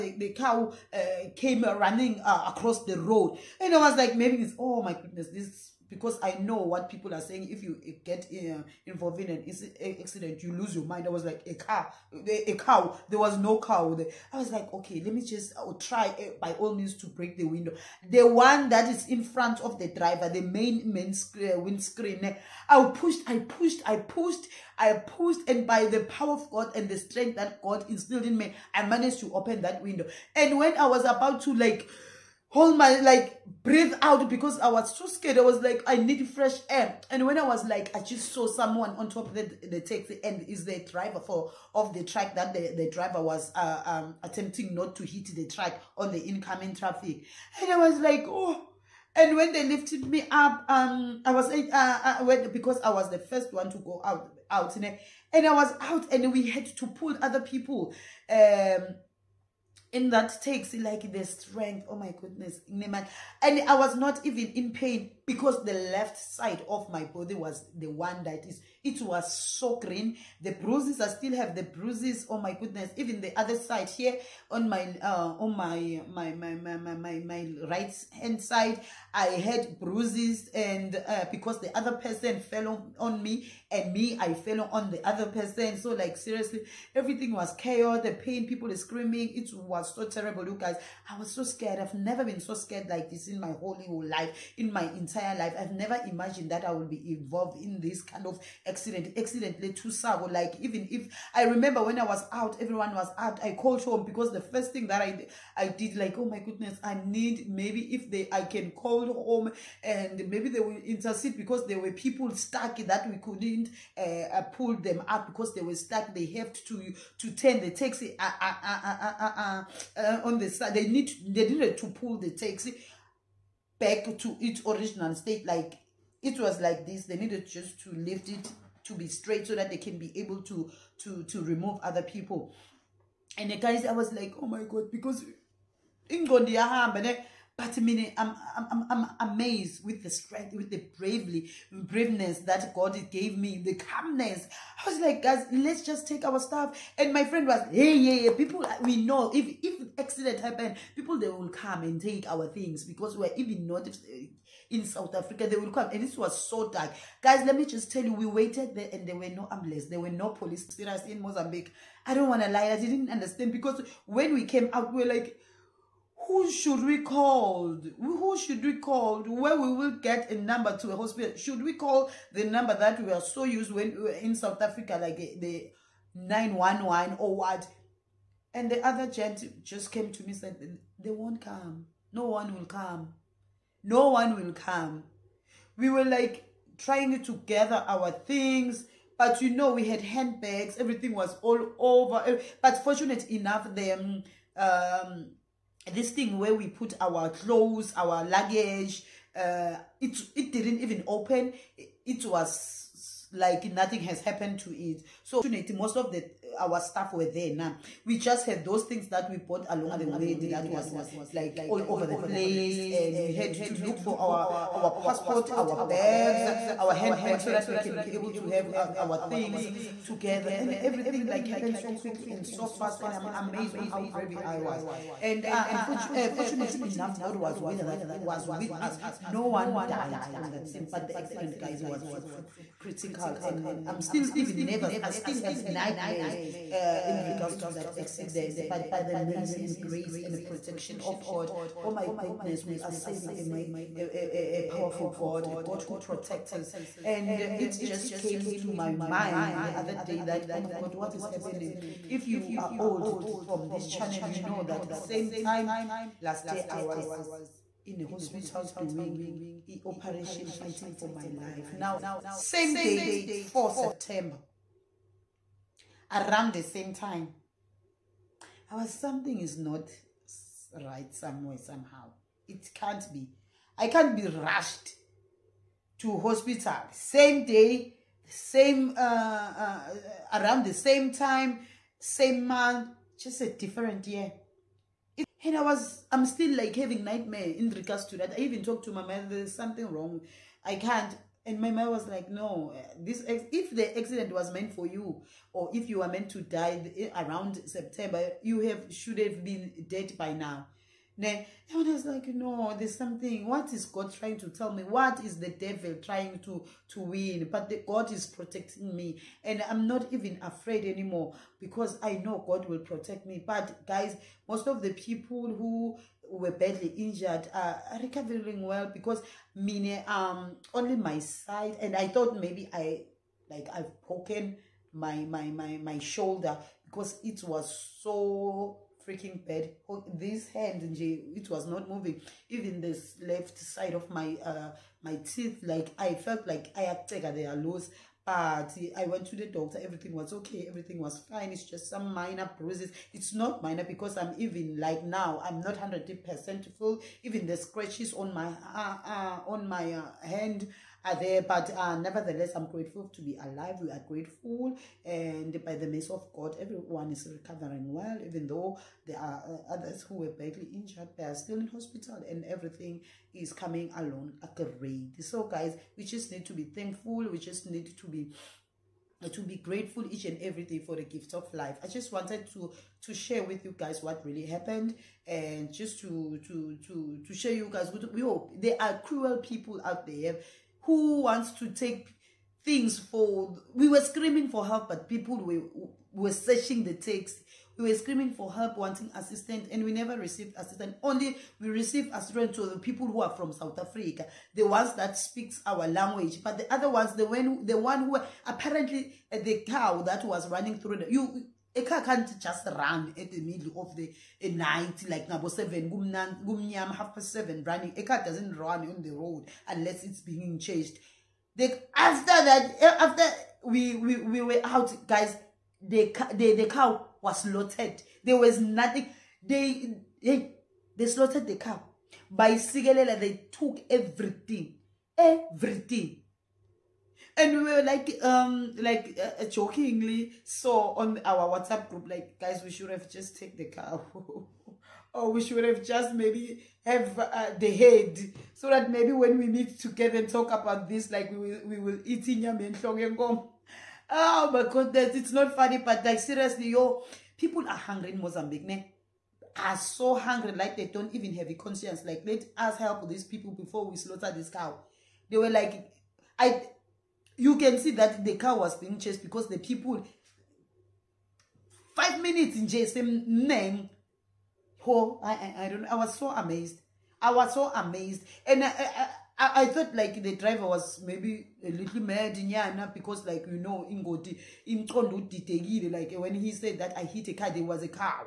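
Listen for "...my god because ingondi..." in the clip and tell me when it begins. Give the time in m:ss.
2:14.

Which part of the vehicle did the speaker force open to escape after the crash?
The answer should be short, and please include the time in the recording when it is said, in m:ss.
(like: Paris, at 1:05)
windscreen, at 0:21.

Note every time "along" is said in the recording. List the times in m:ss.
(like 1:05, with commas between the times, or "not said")
3:29, 6:03.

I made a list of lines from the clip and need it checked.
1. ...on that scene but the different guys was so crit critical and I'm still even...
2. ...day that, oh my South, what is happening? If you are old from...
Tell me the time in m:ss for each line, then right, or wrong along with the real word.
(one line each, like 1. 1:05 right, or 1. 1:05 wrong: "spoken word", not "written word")
1. 3:50 wrong: "accident", not "different"
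2. 4:09 wrong: "God", not "South".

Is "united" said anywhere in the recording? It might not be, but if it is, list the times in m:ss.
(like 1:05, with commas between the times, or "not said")
not said.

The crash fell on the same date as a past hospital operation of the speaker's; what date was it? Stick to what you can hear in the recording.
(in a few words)
4 September.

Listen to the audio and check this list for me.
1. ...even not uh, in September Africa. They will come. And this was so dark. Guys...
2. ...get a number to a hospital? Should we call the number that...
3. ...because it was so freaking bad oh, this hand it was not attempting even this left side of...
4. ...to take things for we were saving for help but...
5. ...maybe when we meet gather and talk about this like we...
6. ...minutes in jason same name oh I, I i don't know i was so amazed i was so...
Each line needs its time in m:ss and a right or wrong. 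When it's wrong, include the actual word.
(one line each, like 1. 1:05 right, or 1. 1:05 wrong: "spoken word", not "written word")
1. 2:33 wrong: "South", not "September"
2. 2:49 right
3. 5:26 wrong: "moving", not "attempting"
4. 6:21 wrong: "screaming", not "saving"
5. 7:18 wrong: "together", not "gather"
6. 7:42 right.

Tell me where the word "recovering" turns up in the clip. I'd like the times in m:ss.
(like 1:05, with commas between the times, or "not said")
5:18, 5:57.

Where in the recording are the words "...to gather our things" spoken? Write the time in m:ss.
3:07.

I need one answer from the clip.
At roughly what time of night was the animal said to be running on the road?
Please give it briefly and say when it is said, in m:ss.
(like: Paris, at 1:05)
half past seven, at 6:46.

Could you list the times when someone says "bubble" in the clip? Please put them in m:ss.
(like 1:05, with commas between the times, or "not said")
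not said.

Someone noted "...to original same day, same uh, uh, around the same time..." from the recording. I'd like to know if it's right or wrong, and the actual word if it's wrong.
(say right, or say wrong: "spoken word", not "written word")
wrong: "hospital", not "original".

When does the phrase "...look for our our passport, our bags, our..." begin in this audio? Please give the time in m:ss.
3:33.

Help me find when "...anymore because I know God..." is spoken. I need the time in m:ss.
5:10.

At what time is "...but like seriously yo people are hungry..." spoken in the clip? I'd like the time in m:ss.
7:25.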